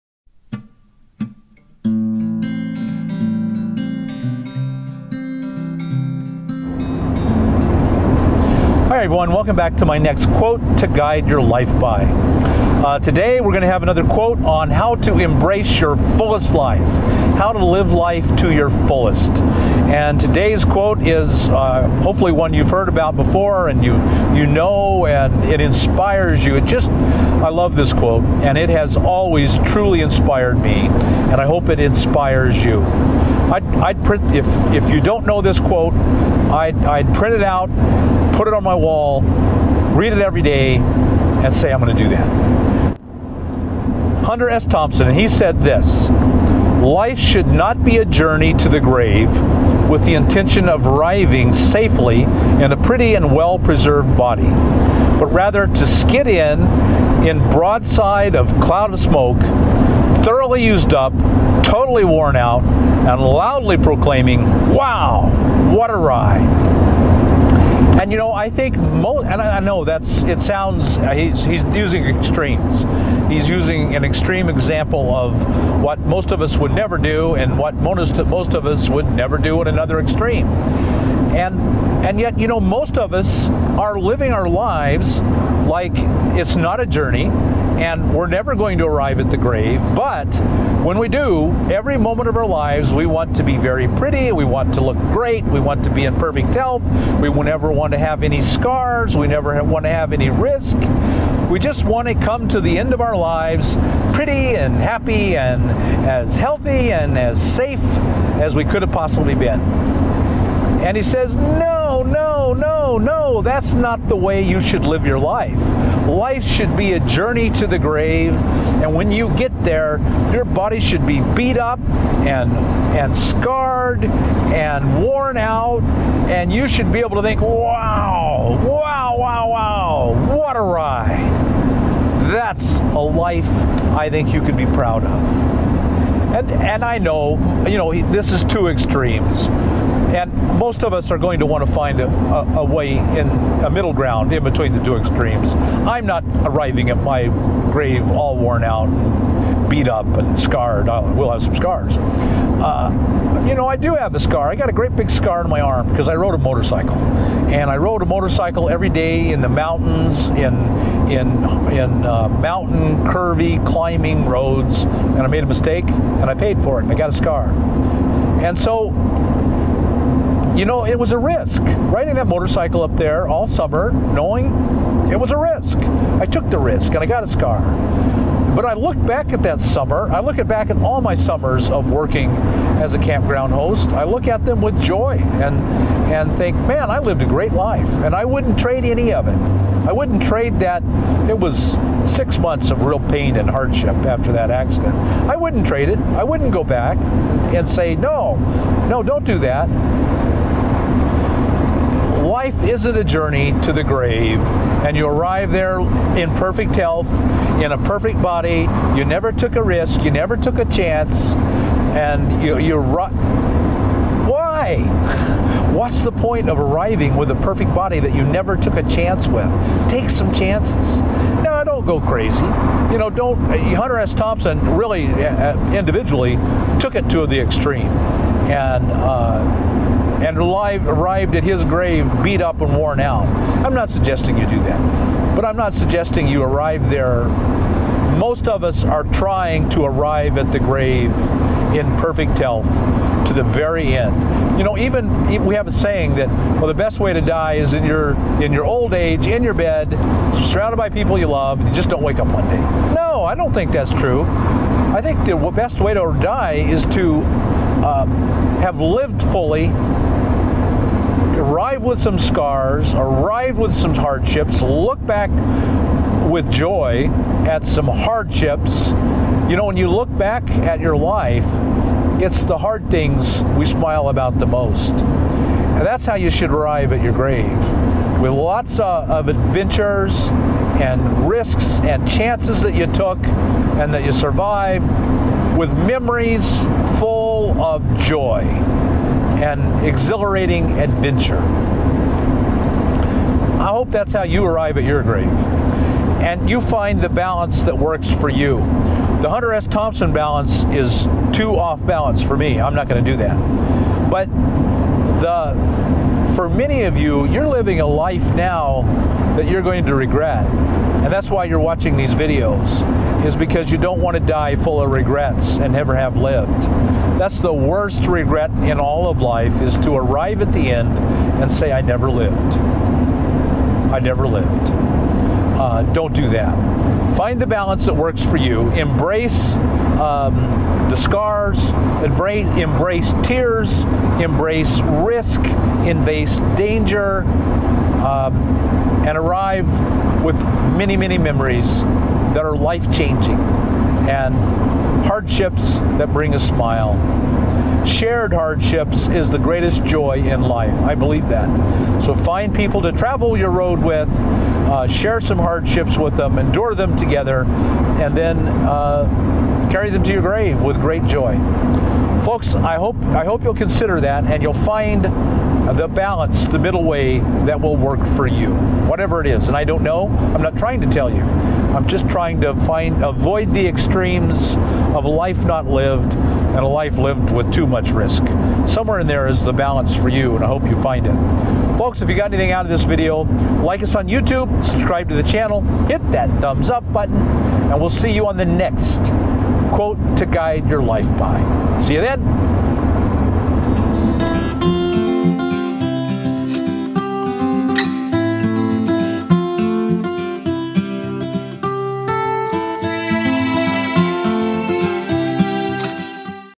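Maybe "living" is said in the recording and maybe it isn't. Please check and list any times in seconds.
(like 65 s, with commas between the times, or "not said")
83 s, 307 s.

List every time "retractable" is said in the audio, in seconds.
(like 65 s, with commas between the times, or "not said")
not said.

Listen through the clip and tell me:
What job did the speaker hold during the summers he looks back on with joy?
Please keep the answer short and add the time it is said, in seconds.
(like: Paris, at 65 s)
Campground host, at 182 s.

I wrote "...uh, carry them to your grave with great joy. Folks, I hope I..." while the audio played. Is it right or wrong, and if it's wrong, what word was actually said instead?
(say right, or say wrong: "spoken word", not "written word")
right.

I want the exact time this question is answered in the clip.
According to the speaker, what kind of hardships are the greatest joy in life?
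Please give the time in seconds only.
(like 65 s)
347 s.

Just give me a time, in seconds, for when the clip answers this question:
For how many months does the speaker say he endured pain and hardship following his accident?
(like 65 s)
192 s.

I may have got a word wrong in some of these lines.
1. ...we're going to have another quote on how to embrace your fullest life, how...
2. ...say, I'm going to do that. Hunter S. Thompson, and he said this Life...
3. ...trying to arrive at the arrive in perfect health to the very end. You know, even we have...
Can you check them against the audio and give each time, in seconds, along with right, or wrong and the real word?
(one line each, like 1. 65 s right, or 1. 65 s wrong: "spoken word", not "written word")
1. 13 s right
2. 41 s right
3. 239 s wrong: "grave", not "arrive".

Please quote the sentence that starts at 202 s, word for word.
Life isn't a journey to the grave, and you arrive there in perfect health, in a perfect body.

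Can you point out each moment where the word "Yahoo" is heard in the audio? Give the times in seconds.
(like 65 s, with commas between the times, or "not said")
not said.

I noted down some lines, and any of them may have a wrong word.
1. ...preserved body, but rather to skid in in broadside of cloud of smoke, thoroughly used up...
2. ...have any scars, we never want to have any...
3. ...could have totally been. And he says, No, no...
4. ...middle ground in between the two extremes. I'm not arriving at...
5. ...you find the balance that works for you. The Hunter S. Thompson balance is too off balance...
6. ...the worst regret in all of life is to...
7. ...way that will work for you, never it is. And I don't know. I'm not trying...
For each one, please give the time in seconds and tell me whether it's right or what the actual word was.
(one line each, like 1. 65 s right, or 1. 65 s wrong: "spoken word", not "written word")
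1. 53 s right
2. 97 s right
3. 108 s wrong: "possibly", not "totally"
4. 143 s right
5. 296 s right
6. 317 s right
7. 366 s wrong: "whatever", not "never".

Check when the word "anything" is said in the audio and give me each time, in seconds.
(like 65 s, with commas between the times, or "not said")
382 s.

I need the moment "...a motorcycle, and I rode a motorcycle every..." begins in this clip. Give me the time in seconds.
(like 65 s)
156 s.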